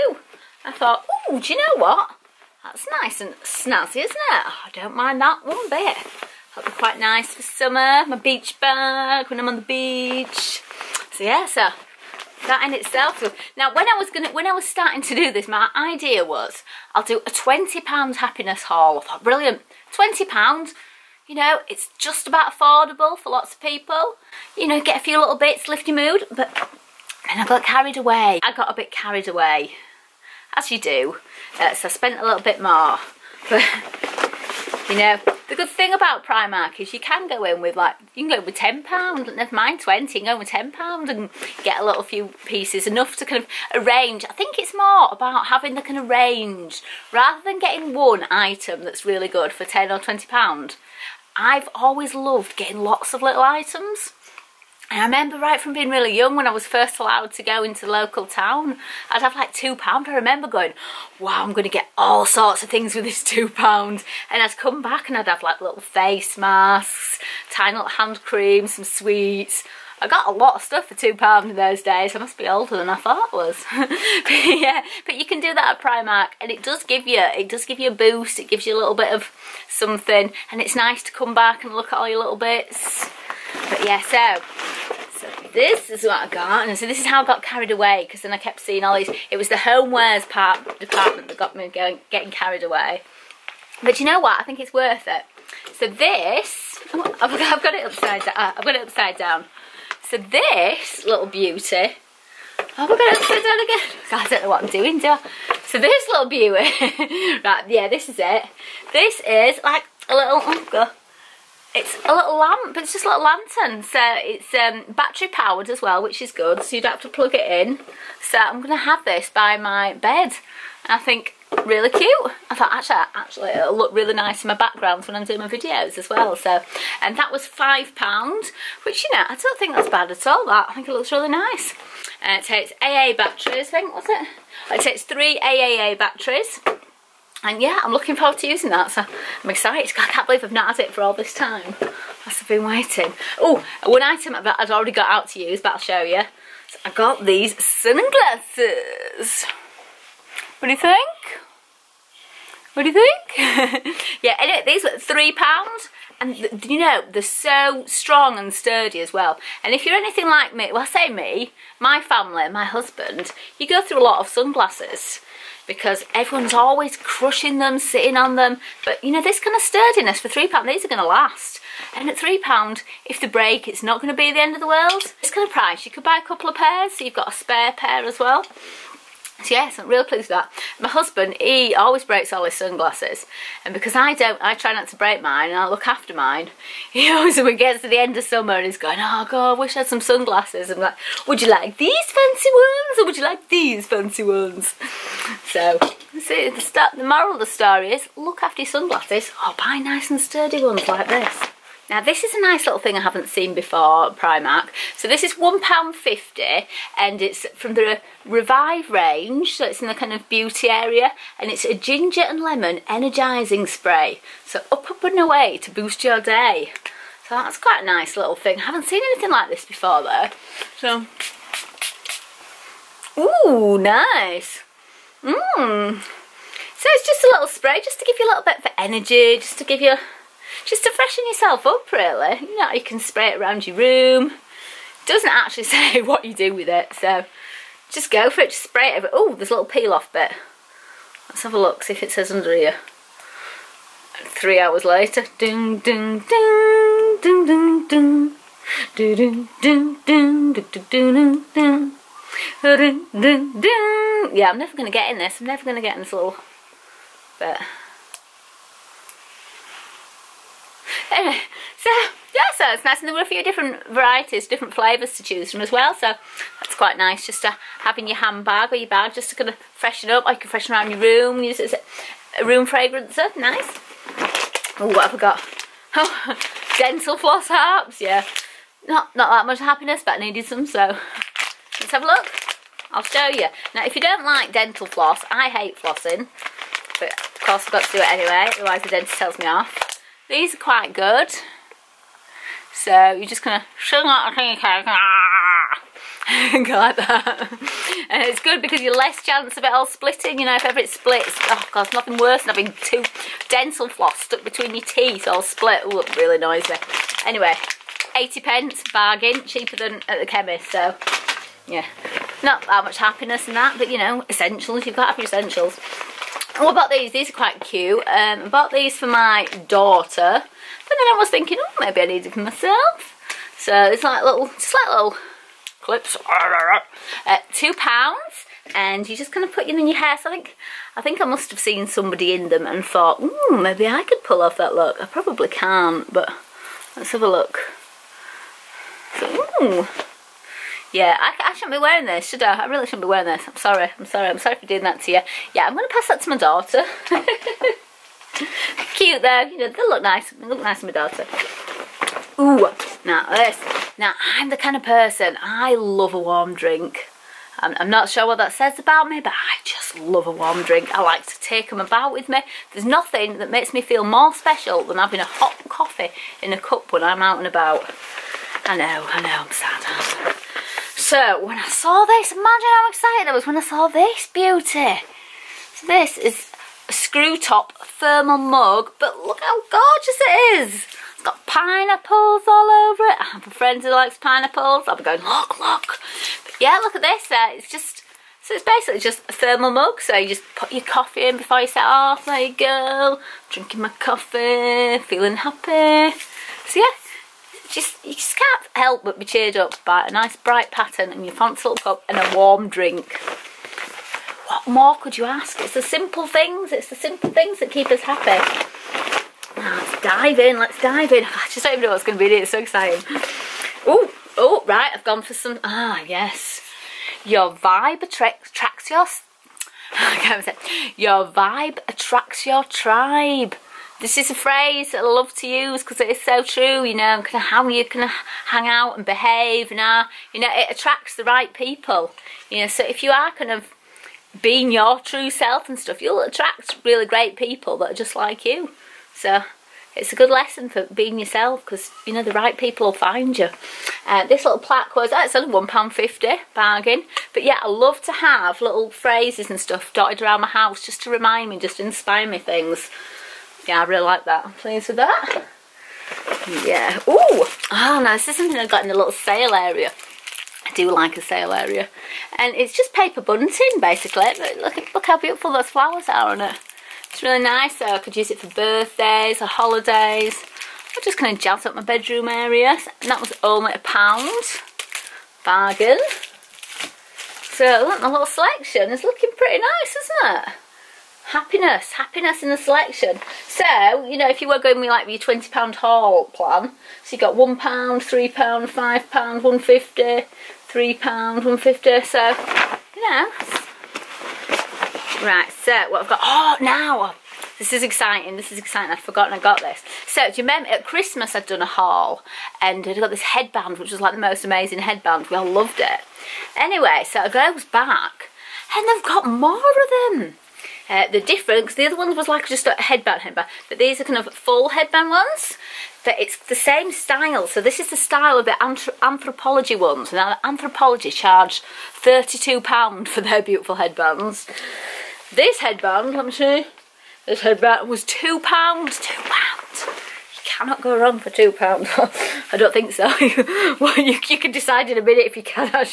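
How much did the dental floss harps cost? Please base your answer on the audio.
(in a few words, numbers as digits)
80p.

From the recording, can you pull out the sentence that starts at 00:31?
Uh, so I spent a little bit more.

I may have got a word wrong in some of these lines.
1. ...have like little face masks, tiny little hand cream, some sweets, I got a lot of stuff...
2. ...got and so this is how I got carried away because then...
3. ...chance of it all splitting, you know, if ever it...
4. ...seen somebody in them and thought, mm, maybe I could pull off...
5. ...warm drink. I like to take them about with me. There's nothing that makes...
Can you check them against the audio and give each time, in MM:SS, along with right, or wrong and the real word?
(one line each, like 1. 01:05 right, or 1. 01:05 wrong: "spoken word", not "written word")
1. 01:05 right
2. 01:26 right
3. 04:59 right
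4. 05:31 right
5. 06:00 right.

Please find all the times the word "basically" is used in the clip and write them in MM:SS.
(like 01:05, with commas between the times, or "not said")
06:28, 07:43.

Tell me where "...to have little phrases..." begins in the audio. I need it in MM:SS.
07:28.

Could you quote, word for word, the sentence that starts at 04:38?
Not, not that much happiness, but I needed some, so let's have a look.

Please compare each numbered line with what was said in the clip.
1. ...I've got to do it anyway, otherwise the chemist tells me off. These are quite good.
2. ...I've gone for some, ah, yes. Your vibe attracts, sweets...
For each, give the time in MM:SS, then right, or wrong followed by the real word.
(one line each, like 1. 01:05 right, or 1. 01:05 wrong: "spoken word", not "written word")
1. 04:47 wrong: "dentist", not "chemist"
2. 06:54 wrong: "attracts", not "sweets".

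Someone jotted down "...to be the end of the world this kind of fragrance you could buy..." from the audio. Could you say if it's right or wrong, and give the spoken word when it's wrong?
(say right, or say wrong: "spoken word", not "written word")
wrong: "price", not "fragrance".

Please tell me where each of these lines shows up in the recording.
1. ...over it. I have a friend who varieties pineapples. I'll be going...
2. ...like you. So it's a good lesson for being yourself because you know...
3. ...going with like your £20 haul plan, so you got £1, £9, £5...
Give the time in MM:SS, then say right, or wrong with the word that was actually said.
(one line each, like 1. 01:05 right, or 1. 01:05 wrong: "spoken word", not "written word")
1. 06:22 wrong: "likes", not "varieties"
2. 07:18 right
3. 08:04 wrong: "3", not "9".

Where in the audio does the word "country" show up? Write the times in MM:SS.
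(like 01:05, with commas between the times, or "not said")
not said.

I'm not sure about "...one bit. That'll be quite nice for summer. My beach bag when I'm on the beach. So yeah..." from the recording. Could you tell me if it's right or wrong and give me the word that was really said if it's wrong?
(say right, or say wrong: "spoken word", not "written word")
right.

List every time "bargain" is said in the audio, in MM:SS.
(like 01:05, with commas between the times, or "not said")
05:08, 07:26, 07:55.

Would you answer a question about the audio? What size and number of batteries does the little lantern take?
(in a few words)
3 AAA.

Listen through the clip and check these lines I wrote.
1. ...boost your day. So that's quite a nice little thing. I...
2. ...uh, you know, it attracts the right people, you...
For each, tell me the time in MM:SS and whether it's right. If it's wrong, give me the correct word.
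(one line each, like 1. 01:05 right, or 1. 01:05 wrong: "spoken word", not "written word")
1. 03:35 right
2. 07:09 right.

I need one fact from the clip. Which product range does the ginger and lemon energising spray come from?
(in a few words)
Revive.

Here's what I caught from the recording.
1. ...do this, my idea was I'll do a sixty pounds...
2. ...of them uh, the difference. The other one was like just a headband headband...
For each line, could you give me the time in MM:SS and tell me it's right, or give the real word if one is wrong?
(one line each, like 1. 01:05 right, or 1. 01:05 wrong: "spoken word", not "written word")
1. 00:15 wrong: "twenty", not "sixty"
2. 08:29 right.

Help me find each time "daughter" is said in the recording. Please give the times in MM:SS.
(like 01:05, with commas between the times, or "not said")
05:19, 05:46, 05:50.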